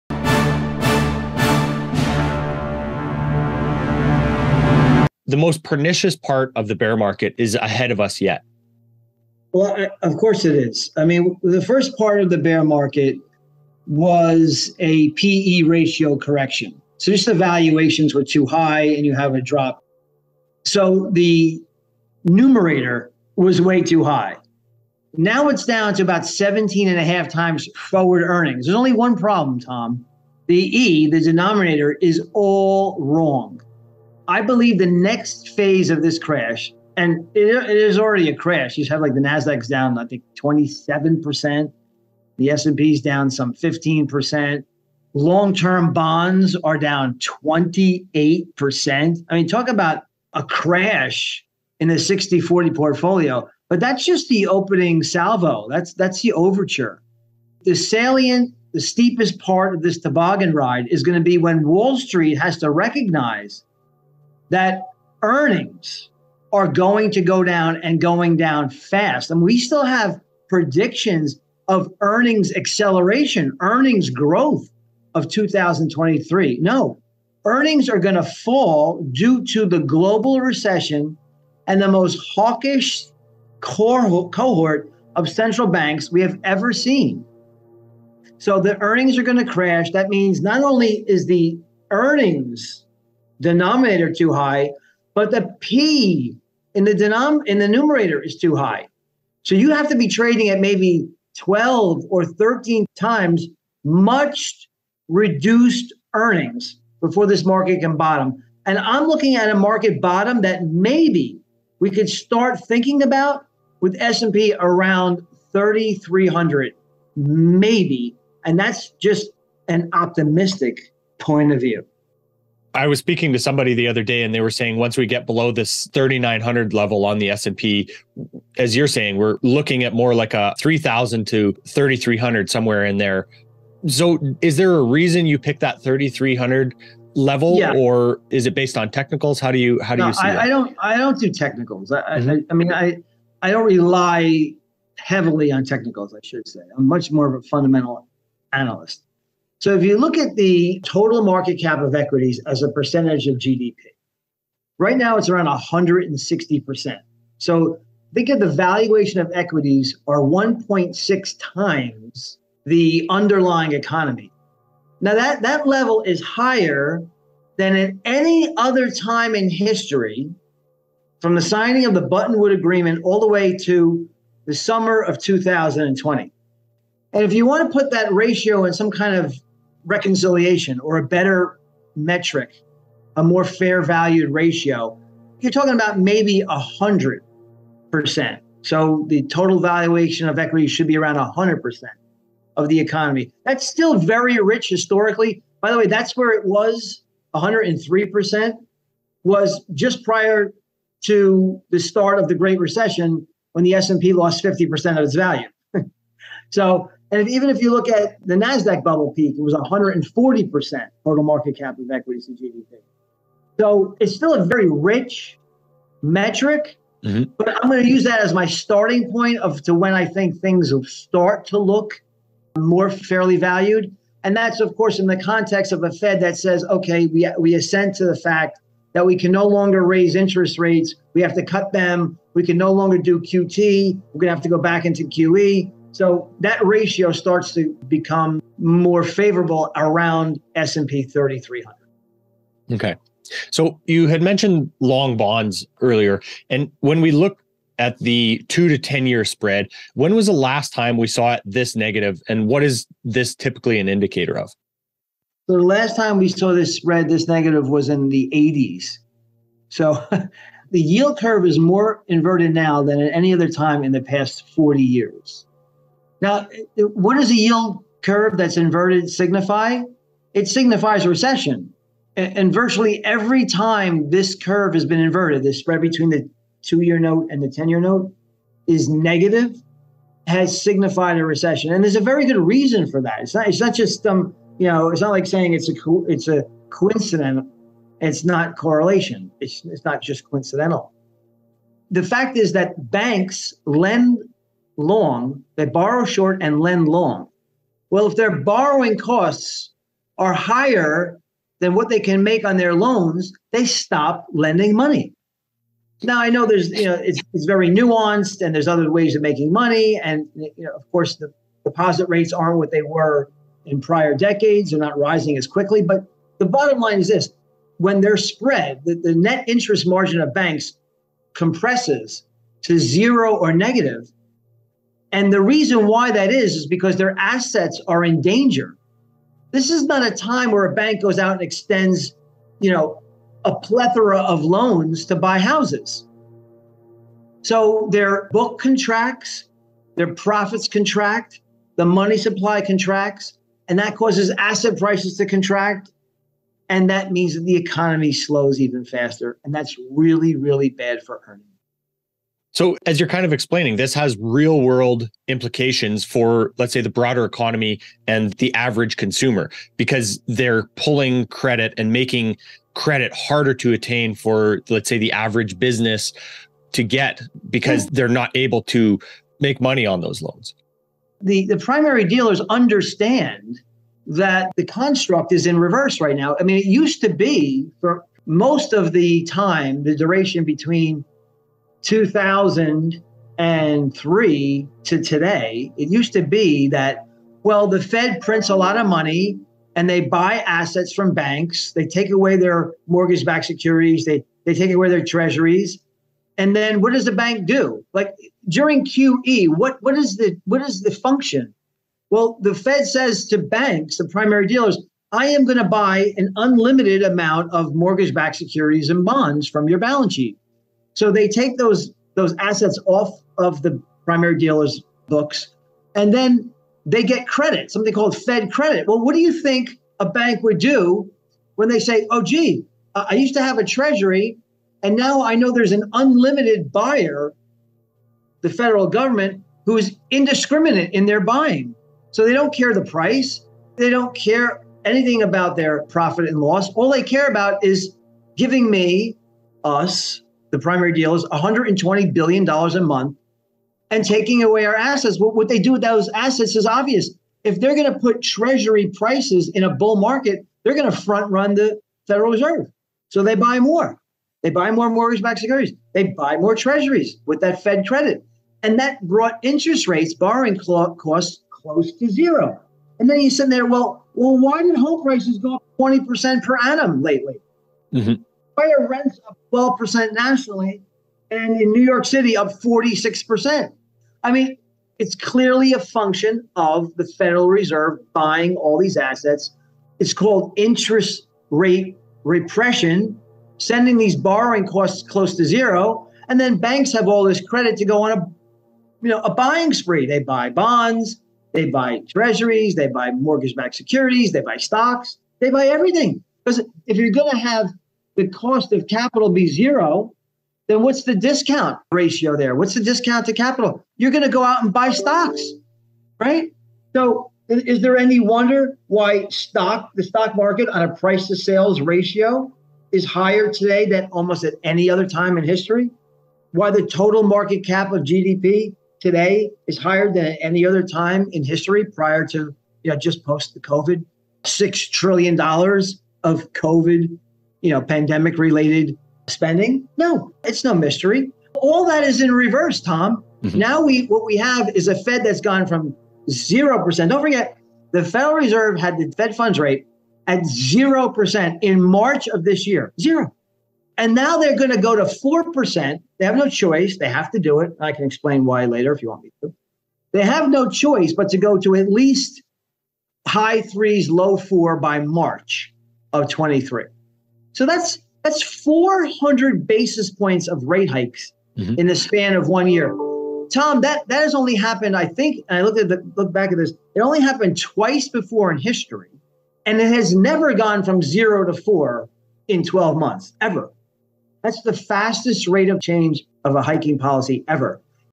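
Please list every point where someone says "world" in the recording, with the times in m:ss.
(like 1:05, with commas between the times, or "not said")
5:54.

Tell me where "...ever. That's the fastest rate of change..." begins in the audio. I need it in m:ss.
9:33.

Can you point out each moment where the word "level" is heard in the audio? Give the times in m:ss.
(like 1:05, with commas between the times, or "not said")
2:06, 2:17, 2:45.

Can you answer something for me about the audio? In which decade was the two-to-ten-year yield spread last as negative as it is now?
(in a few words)
the 80s.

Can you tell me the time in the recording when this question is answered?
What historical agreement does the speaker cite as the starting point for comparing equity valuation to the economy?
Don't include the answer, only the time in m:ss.
2:52.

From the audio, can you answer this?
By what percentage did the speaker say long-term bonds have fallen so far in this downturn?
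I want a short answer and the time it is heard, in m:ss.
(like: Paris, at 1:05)
28 percent, at 0:47.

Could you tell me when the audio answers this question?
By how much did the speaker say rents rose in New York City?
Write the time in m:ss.
7:52.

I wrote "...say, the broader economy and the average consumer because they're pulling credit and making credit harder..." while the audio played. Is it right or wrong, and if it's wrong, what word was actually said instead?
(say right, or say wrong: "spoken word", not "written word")
right.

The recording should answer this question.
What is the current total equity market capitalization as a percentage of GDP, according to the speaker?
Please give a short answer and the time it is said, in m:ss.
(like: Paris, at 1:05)
160%, at 2:35.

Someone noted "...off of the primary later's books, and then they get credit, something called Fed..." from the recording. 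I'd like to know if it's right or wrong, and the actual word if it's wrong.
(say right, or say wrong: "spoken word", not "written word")
wrong: "dealer", not "later".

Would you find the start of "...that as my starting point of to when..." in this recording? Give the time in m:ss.
3:38.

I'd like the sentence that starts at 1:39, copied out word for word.
So you have to be trading at maybe 12 or 13 times much reduced earnings before this market can bottom.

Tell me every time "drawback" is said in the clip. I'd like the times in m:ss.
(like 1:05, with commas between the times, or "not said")
not said.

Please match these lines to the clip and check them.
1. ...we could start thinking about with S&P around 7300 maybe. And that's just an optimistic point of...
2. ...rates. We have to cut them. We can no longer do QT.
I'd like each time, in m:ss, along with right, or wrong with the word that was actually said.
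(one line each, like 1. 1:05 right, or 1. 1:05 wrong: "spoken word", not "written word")
1. 1:51 wrong: "3300", not "7300"
2. 3:50 right.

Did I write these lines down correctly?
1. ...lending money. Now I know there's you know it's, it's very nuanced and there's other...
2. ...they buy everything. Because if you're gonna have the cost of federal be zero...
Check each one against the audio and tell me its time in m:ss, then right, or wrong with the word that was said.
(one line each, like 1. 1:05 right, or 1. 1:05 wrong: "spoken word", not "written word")
1. 5:04 right
2. 8:15 wrong: "capital", not "federal".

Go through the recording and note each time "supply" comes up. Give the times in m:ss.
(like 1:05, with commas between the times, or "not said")
5:42.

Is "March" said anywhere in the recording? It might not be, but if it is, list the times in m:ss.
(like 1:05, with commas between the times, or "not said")
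9:01, 9:14.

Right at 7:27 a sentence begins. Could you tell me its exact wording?
If they're going to put treasury prices in a bull market, they're going to front run the Federal Reserve.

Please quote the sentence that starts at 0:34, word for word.
I believe the next phase of this crash, and it, it is already a crash.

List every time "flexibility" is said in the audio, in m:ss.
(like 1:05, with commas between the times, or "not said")
not said.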